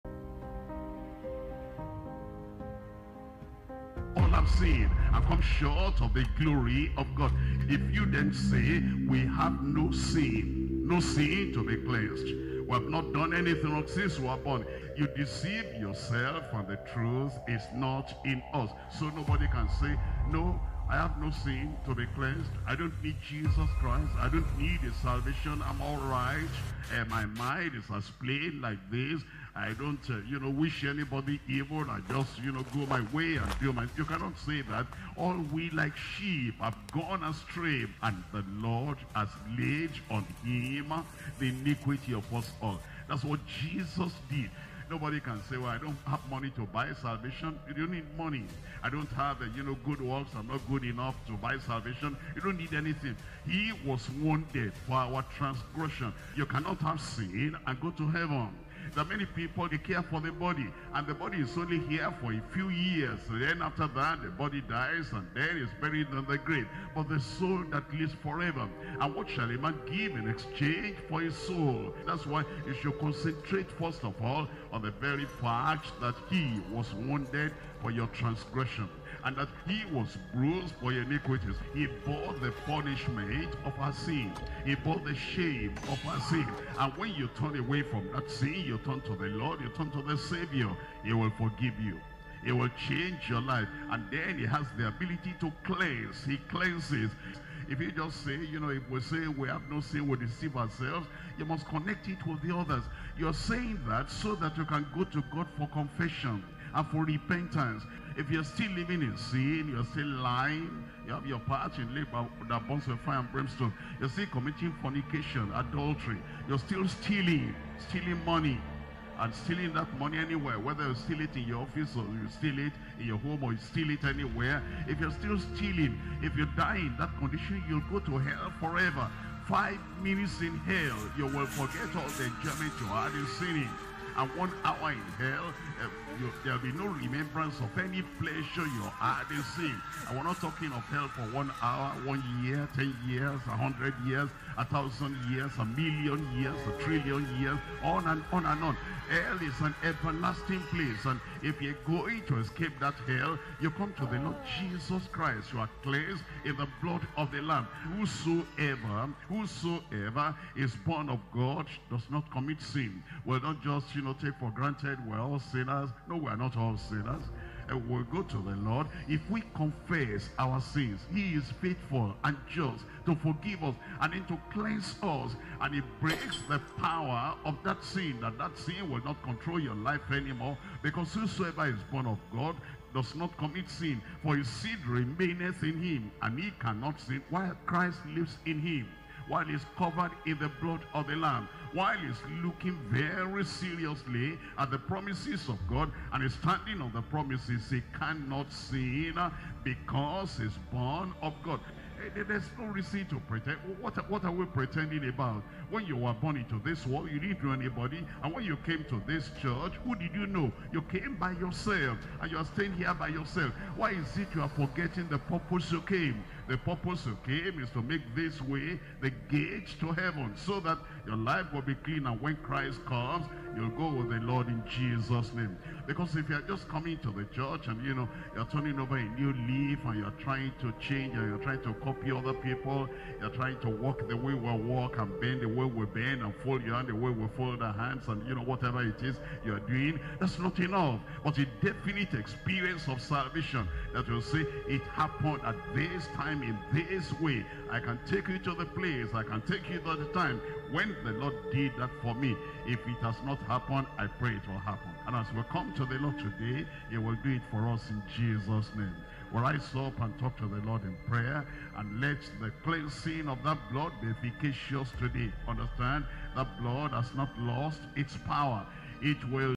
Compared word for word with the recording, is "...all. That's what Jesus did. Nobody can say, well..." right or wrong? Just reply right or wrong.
right.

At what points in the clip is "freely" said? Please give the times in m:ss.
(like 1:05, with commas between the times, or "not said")
not said.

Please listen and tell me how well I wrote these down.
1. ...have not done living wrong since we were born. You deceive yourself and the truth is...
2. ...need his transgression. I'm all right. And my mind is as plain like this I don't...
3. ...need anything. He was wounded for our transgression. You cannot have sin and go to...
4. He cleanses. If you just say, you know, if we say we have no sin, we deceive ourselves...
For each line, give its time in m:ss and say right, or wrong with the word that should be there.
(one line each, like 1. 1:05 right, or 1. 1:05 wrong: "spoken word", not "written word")
1. 0:12 wrong: "anything", not "living"
2. 0:24 wrong: "salvation", not "transgression"
3. 0:52 right
4. 1:36 right.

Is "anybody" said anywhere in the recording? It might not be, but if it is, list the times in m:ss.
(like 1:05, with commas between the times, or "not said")
0:30, 3:27.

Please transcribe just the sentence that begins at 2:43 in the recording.
Will not just, you take for granted we're all sinners.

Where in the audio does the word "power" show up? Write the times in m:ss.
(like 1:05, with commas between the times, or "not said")
2:56, 4:28.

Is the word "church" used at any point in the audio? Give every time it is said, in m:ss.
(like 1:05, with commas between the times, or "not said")
3:29, 3:47.